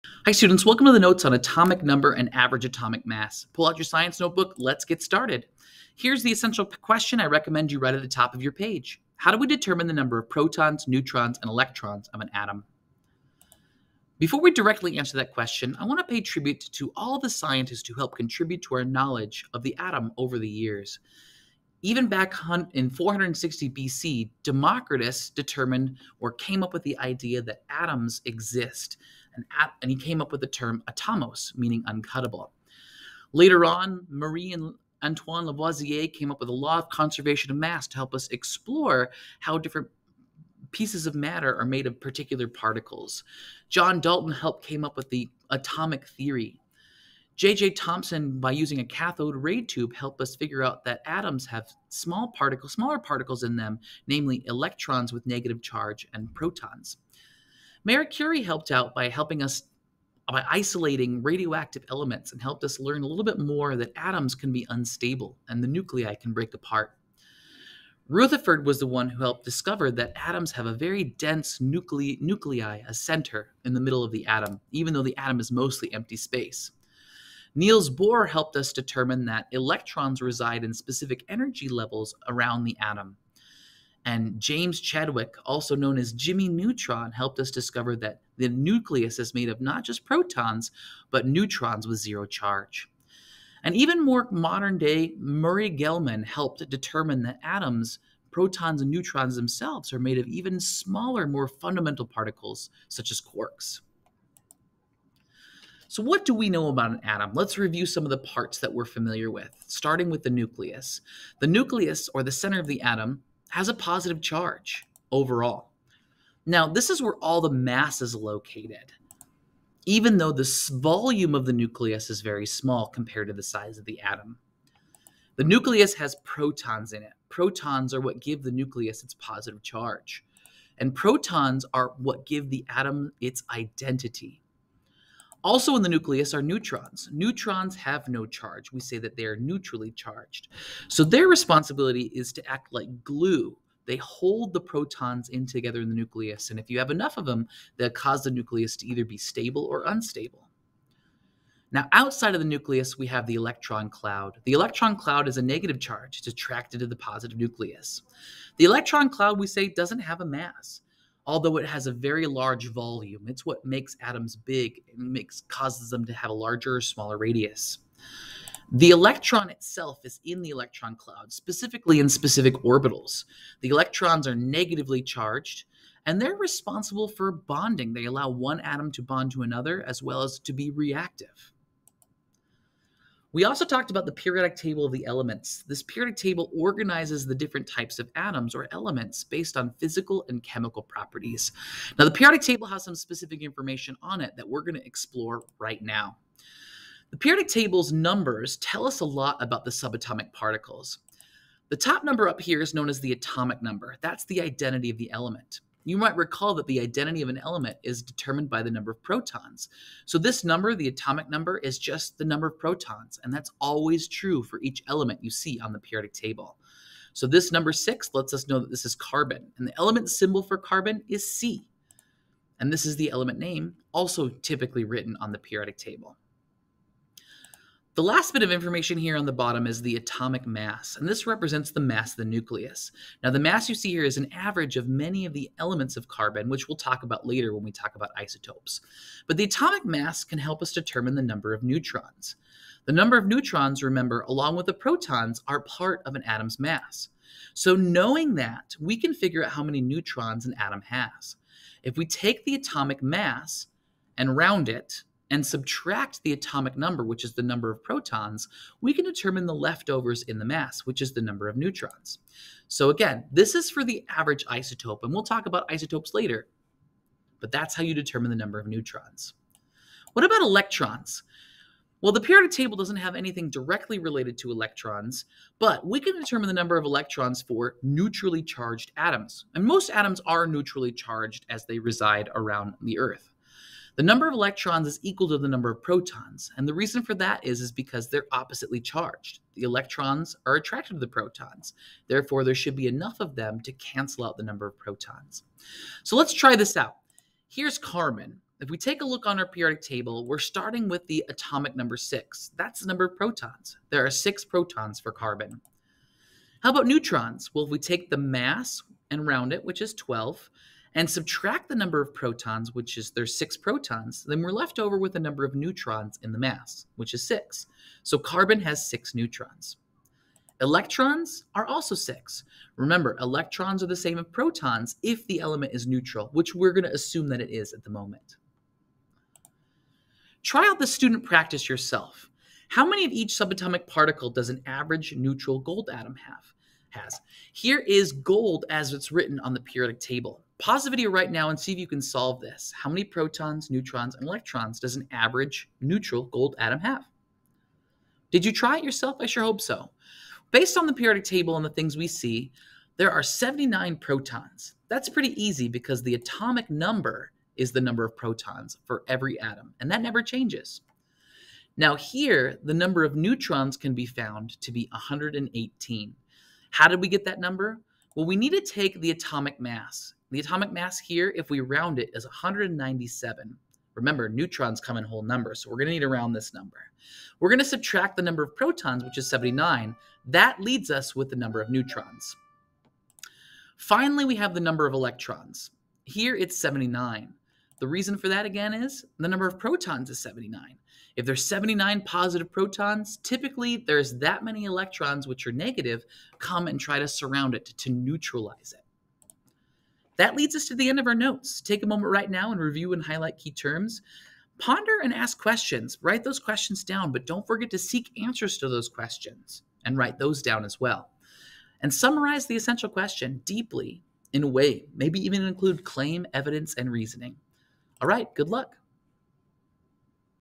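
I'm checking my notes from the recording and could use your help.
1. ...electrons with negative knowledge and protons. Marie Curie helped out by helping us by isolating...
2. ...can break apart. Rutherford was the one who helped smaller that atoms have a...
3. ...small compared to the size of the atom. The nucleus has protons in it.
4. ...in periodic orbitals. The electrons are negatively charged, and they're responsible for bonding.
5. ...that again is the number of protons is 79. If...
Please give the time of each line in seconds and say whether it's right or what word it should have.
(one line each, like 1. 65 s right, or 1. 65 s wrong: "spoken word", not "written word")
1. 54 s wrong: "charge", not "knowledge"
2. 66 s wrong: "discover", not "smaller"
3. 122 s right
4. 171 s wrong: "specific", not "periodic"
5. 388 s right.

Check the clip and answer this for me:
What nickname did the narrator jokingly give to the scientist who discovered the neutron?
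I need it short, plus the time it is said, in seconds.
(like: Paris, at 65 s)
Jimmy Neutron, at 86 s.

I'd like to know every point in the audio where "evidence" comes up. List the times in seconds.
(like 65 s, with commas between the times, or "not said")
416 s.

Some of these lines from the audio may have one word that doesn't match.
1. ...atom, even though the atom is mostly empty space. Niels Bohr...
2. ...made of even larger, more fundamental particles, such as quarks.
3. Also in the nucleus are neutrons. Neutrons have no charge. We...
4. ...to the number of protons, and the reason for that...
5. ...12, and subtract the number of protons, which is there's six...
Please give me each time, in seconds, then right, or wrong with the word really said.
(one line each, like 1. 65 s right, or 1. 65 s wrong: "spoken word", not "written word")
1. 74 s right
2. 99 s wrong: "smaller", not "larger"
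3. 135 s right
4. 285 s right
5. 309 s right.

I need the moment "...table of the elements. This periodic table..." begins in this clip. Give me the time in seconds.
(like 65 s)
184 s.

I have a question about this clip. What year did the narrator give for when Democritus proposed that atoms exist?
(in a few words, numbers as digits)
460 BC.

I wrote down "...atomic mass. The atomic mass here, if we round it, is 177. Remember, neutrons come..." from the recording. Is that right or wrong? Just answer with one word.
wrong.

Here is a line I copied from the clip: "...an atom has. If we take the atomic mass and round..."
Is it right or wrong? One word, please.
right.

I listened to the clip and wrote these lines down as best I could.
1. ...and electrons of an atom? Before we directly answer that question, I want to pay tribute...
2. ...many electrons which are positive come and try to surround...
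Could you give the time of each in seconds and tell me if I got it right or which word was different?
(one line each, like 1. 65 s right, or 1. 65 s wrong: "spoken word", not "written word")
1. 11 s right
2. 394 s wrong: "negative", not "positive".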